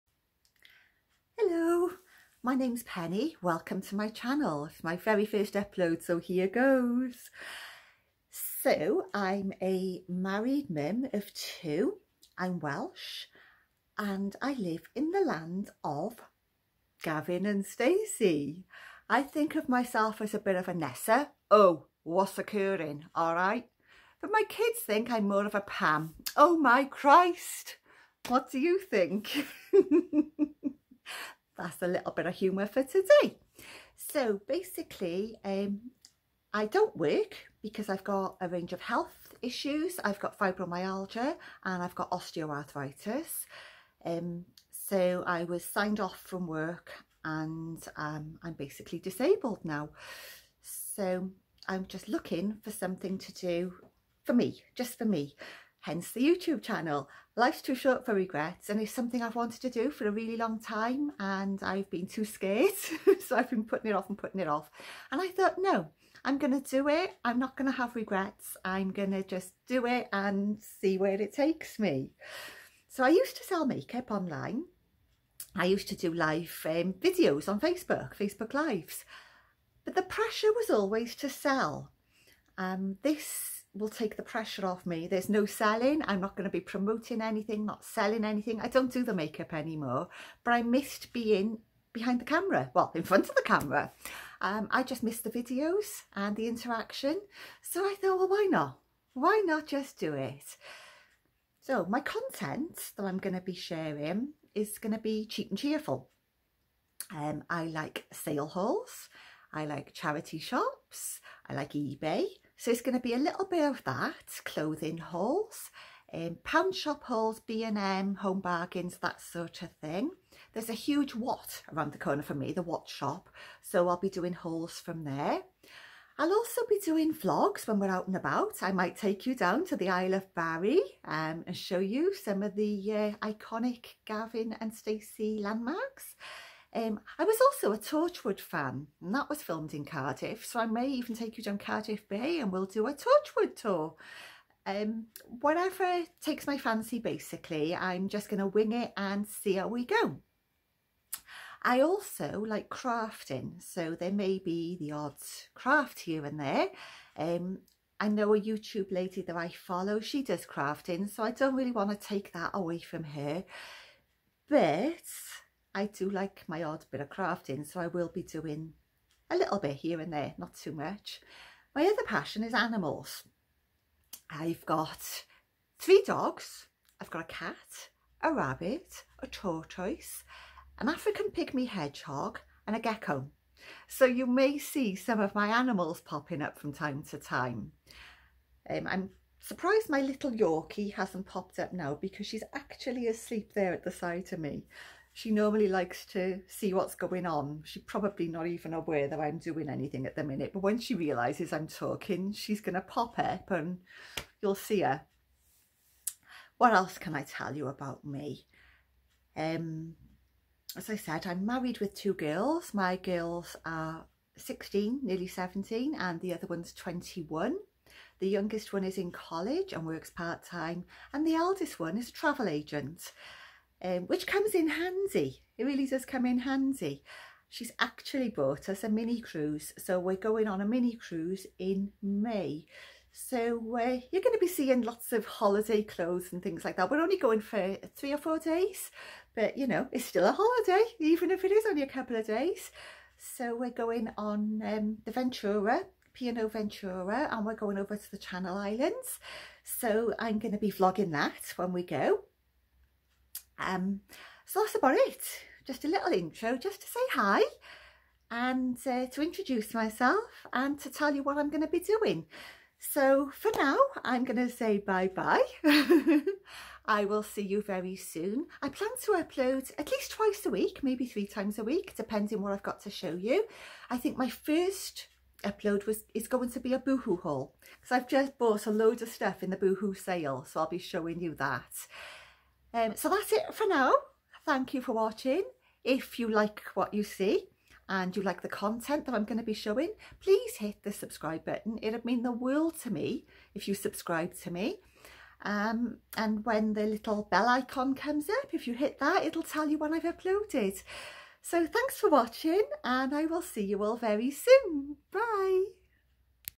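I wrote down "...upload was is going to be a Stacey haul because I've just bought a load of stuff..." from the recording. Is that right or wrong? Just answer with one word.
wrong.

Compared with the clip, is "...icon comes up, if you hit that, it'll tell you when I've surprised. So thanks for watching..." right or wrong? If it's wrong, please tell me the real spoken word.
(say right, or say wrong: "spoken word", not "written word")
wrong: "uploaded", not "surprised".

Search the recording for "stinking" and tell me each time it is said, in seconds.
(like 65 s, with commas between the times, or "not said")
not said.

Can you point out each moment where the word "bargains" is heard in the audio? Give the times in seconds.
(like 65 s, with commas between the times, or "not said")
118 s.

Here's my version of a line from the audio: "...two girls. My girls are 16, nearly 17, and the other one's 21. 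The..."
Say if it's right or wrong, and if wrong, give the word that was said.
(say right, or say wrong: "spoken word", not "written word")
right.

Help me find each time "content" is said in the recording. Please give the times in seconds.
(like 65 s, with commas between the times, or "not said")
101 s, 288 s.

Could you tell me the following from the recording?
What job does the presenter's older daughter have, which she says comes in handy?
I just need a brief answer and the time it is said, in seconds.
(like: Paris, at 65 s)
Travel agent, at 222 s.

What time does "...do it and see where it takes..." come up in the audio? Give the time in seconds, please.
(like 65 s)
69 s.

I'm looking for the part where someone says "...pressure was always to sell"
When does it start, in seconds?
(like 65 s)
80 s.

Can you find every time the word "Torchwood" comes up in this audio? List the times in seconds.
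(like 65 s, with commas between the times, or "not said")
137 s, 142 s.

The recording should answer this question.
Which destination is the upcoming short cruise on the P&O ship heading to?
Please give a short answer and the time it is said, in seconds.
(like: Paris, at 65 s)
The Channel Islands, at 248 s.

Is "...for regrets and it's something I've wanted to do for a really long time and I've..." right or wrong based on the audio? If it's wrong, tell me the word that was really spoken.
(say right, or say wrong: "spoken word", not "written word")
right.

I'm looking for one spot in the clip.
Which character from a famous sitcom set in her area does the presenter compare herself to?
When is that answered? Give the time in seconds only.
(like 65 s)
20 s.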